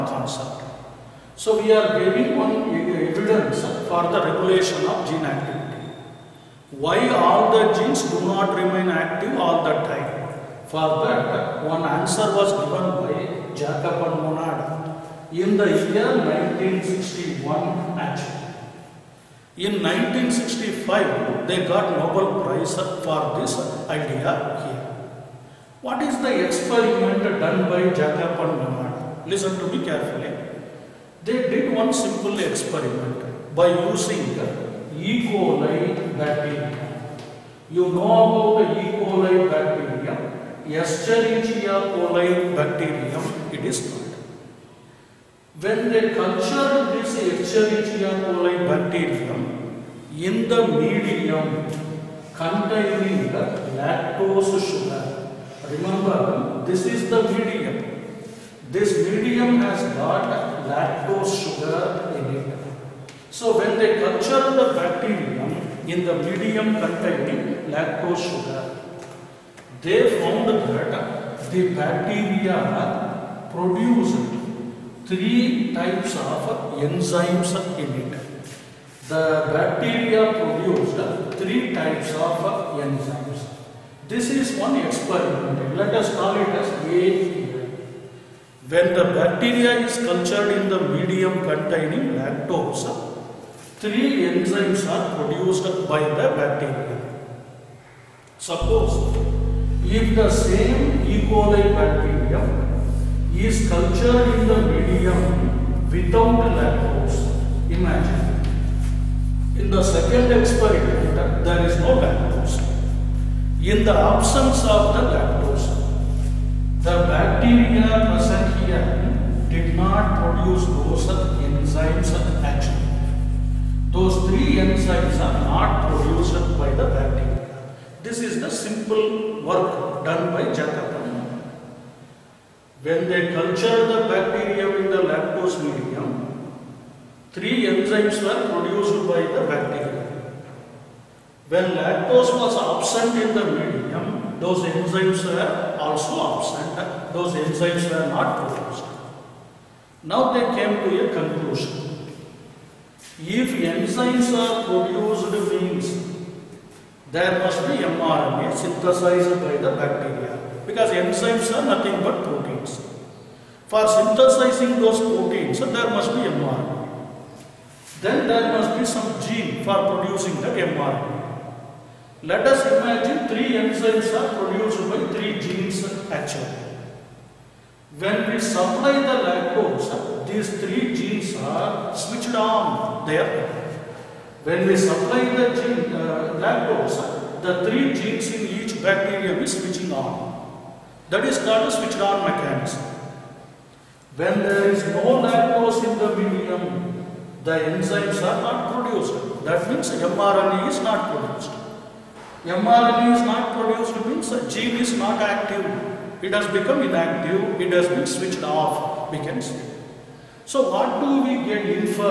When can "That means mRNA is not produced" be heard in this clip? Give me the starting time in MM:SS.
03:19.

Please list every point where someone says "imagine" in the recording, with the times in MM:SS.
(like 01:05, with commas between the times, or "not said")
01:47, 02:52.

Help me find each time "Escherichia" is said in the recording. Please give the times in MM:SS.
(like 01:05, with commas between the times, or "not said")
00:40, 00:47.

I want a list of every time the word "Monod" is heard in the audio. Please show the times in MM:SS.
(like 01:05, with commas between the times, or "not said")
00:14, 00:28.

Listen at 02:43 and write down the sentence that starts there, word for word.
For synthesizing those proteins, there must be mRNA.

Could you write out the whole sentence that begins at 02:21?
When lactose was absent in the medium, those enzymes were also absent.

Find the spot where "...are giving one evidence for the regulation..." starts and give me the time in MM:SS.
00:01.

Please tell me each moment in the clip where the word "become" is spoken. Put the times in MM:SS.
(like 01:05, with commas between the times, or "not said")
03:26.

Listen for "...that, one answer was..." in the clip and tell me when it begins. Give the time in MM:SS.
00:11.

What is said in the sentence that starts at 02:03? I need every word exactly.
Those three enzymes are not produced by the bacteria.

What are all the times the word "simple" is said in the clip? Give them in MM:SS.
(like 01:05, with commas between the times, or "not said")
00:31, 02:08.